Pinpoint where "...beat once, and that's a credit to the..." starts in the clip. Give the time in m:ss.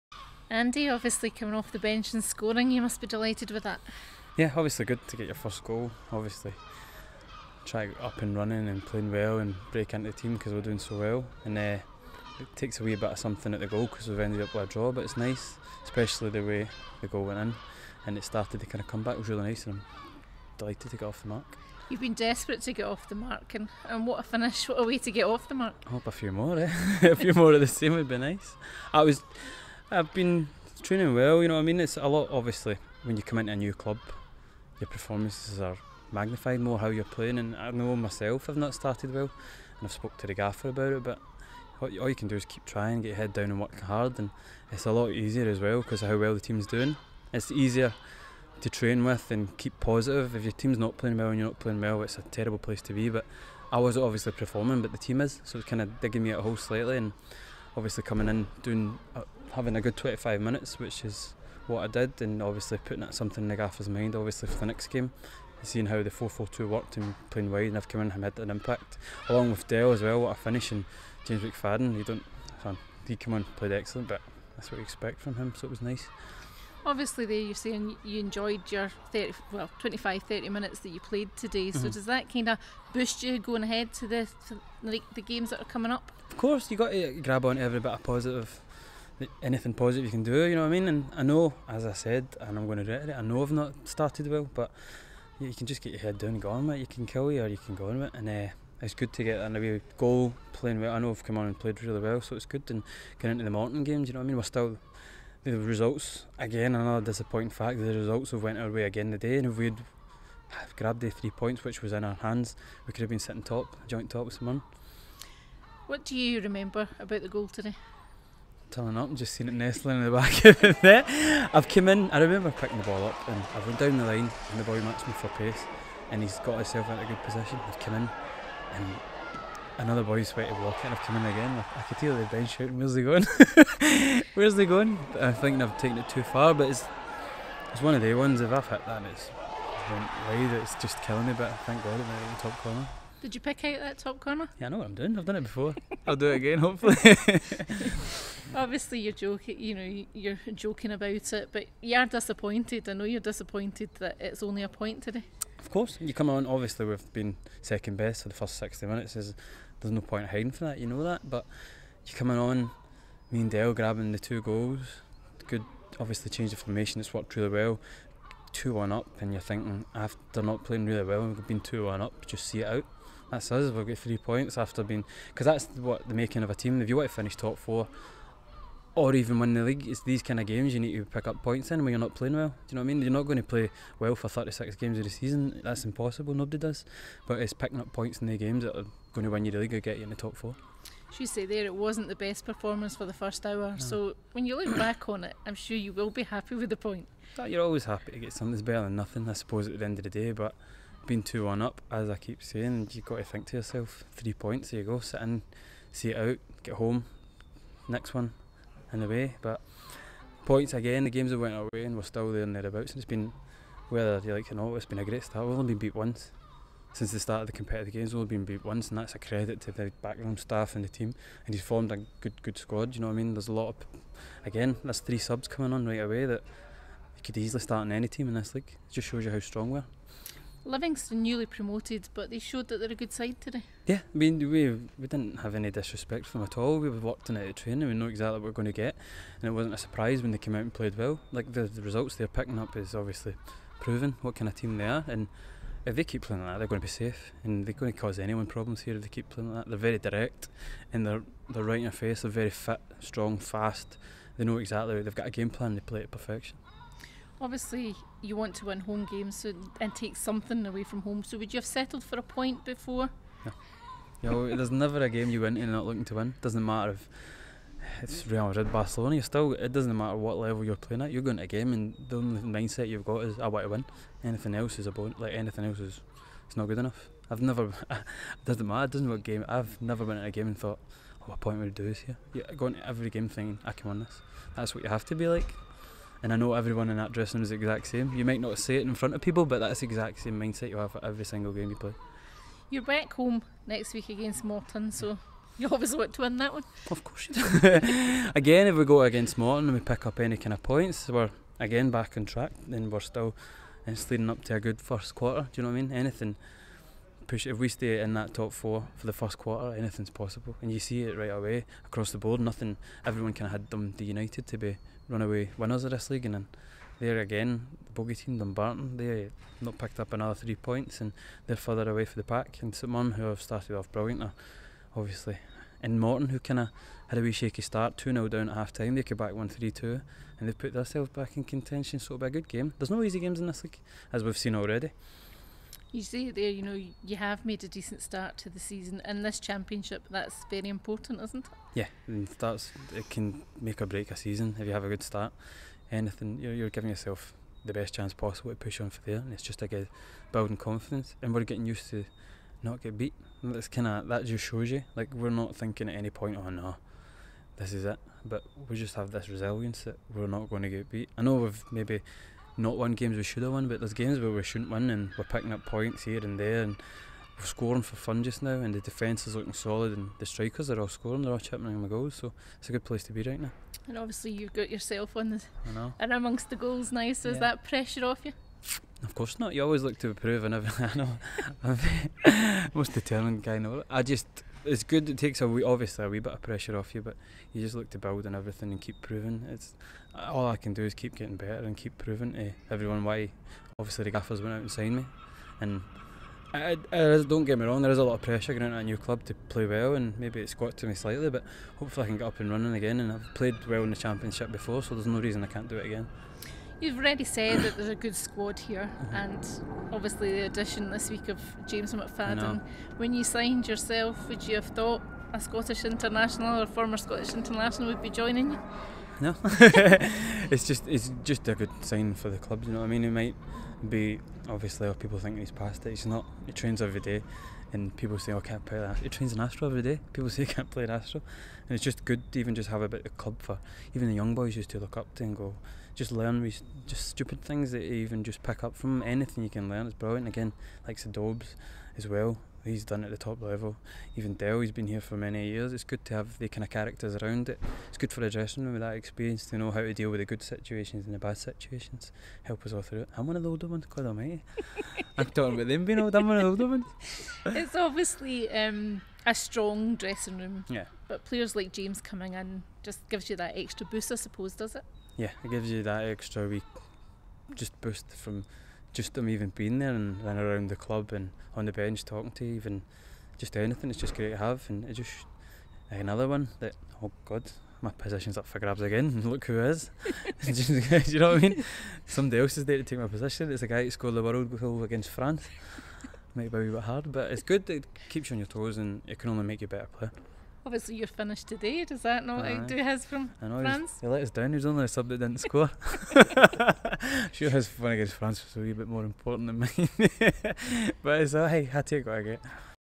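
3:38.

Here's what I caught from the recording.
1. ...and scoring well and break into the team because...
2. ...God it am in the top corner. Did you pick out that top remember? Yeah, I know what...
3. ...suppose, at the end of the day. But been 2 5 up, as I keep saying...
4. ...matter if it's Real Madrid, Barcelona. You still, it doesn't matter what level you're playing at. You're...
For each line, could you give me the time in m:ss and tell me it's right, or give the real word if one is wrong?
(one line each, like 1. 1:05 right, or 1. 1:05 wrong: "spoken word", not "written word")
1. 0:08 wrong: "playing", not "scoring"
2. 2:21 wrong: "corner", not "remember"
3. 3:19 wrong: "1", not "5"
4. 4:26 right.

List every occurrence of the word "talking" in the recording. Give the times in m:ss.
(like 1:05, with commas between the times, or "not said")
7:35, 7:52.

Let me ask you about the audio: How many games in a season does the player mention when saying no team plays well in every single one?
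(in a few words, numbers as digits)
36.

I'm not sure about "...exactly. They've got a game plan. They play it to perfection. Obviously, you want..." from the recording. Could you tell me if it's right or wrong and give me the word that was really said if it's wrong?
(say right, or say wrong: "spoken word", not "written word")
right.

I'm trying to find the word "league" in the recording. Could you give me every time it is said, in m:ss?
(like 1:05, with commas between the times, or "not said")
2:59, 3:09, 3:48, 5:16, 5:33.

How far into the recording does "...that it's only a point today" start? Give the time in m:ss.
2:33.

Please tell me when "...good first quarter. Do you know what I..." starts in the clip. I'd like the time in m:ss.
5:04.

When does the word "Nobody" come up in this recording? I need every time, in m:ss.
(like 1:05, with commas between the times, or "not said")
3:06.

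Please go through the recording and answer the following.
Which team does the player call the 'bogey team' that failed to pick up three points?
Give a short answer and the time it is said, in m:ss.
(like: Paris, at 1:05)
Dumbarton, at 5:18.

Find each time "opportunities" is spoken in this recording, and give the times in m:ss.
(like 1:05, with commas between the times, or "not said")
not said.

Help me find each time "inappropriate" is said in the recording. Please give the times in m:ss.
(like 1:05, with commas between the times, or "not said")
not said.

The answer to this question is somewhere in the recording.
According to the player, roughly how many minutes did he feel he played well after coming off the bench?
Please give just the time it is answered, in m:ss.
0:59.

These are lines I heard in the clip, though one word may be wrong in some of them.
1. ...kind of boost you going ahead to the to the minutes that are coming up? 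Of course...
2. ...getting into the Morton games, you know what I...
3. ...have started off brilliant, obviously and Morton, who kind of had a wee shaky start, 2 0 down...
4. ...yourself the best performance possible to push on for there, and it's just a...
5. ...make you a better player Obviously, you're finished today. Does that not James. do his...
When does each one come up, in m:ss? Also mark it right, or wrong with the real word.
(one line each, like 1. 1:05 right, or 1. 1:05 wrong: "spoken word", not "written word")
1. 1:22 wrong: "games", not "minutes"
2. 1:43 right
3. 5:23 right
4. 5:46 wrong: "chance", not "performance"
5. 8:09 wrong: "Aye", not "James".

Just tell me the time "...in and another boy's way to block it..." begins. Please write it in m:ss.
2:07.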